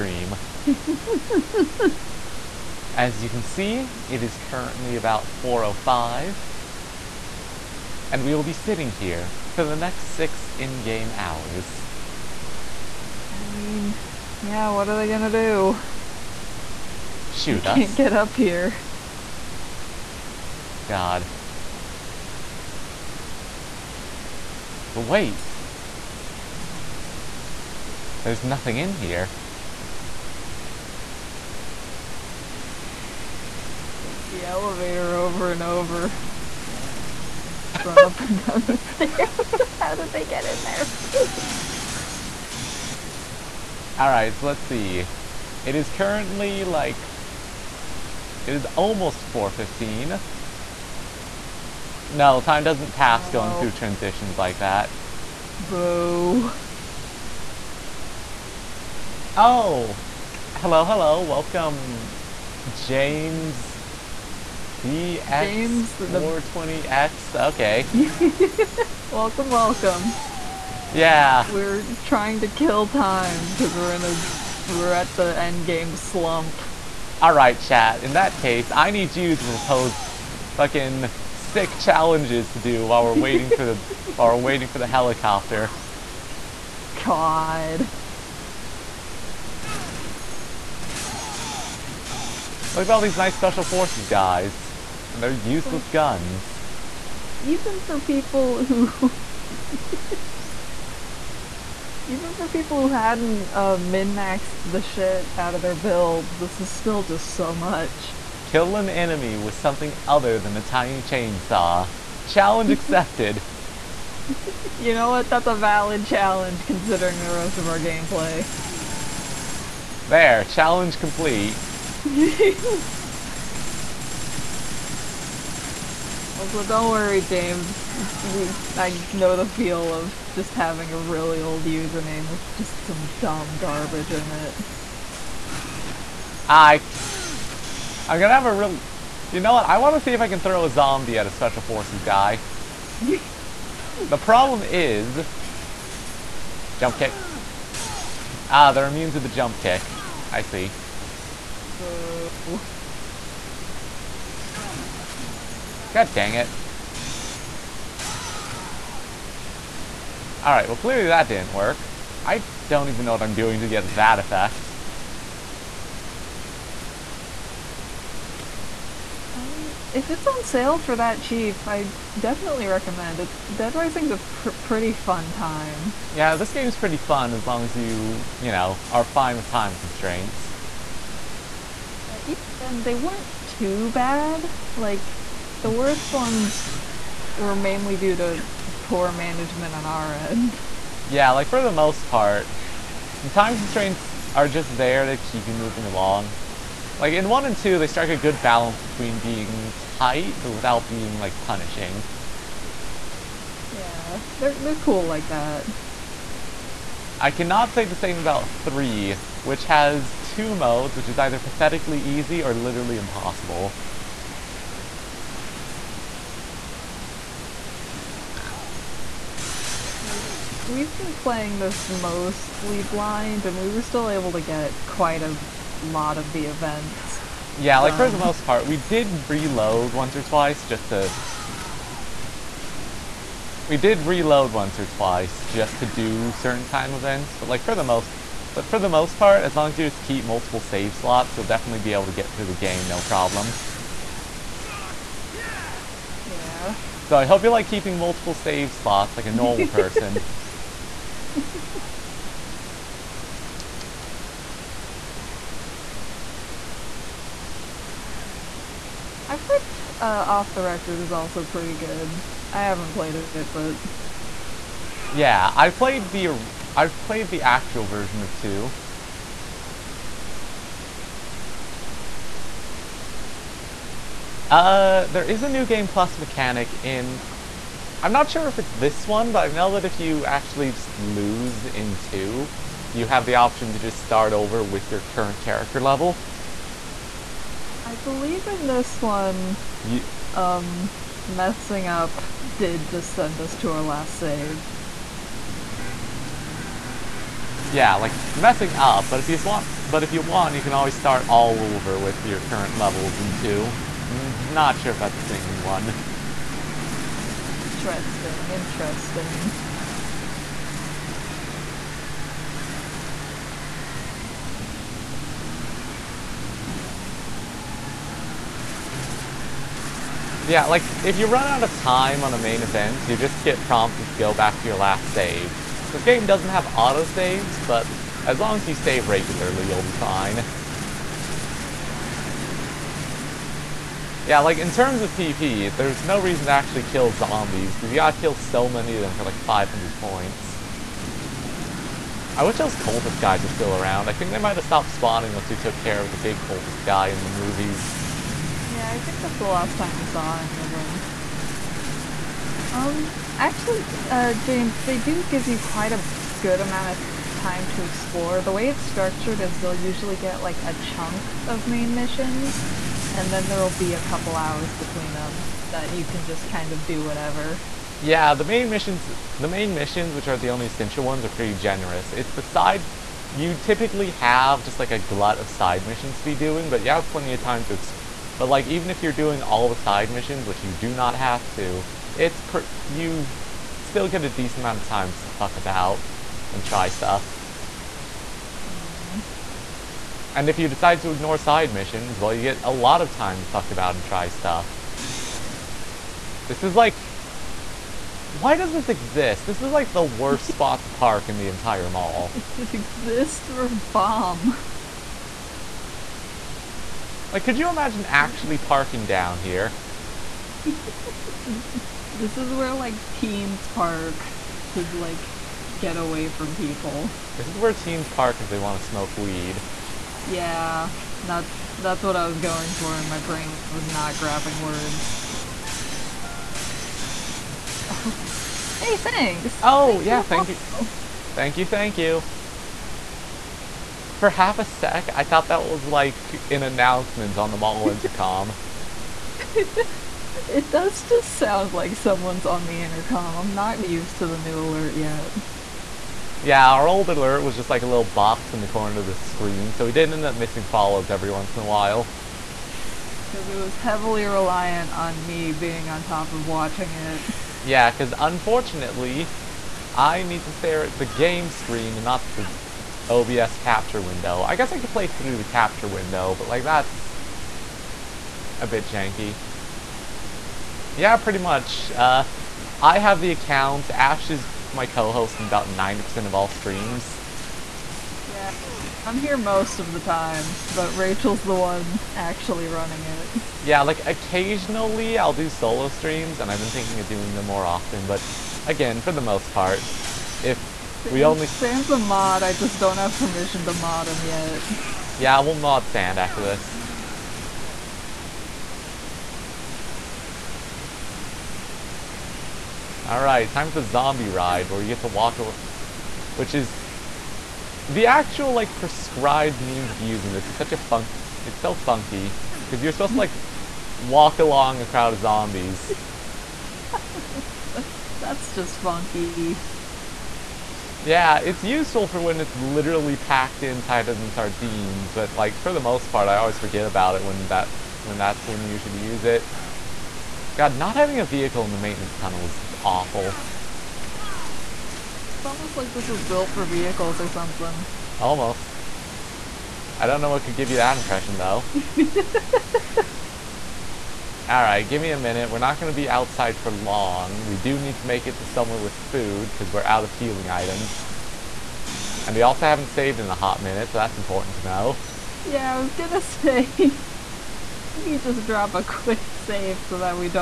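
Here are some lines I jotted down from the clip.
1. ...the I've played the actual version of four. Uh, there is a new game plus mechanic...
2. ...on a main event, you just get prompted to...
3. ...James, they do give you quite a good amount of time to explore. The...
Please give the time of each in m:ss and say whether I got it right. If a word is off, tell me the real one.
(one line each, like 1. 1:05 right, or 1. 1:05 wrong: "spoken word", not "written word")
1. 4:26 wrong: "two", not "four"
2. 5:22 right
3. 5:54 right.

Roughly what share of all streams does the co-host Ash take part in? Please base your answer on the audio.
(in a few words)
90%.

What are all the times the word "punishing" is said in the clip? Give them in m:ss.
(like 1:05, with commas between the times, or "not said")
3:21.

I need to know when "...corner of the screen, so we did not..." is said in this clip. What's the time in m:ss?
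7:28.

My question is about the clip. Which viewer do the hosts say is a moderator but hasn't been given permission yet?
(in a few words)
Sam.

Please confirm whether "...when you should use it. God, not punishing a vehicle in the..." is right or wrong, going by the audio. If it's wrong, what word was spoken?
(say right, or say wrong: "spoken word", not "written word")
wrong: "having", not "punishing".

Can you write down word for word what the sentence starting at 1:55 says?
That's a valid challenge considering the rest of our gameplay.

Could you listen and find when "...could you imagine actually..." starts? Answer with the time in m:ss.
6:47.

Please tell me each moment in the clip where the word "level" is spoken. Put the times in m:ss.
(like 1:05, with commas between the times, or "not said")
4:45, 5:02.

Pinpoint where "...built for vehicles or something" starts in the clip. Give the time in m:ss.
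8:56.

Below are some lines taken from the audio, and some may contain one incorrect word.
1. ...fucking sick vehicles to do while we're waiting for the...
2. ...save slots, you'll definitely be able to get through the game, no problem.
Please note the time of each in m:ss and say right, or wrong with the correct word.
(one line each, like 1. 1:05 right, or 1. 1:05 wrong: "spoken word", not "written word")
1. 1:19 wrong: "challenges", not "vehicles"
2. 4:00 right.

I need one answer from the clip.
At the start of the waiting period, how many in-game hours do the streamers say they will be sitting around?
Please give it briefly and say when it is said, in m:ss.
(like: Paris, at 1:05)
6, at 0:10.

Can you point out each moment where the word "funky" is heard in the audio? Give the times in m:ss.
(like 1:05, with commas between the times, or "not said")
8:31, 8:38.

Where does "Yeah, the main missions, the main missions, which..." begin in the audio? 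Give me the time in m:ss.
6:07.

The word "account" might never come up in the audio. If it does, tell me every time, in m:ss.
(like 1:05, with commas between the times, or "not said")
7:53.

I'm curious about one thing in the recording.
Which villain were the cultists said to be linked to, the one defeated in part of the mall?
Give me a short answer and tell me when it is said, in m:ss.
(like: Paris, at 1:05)
Big cultist guy in the movies, at 5:47.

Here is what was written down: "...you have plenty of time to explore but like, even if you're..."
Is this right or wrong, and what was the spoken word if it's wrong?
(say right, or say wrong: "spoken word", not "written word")
right.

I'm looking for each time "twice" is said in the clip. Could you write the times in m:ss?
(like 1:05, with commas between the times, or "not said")
3:50, 3:54.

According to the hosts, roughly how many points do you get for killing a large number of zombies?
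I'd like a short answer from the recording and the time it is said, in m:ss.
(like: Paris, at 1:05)
500, at 5:39.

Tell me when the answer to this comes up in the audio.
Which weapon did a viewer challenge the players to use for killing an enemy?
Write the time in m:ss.
1:50.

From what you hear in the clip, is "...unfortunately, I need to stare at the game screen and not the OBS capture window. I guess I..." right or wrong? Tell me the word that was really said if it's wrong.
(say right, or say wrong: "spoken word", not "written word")
right.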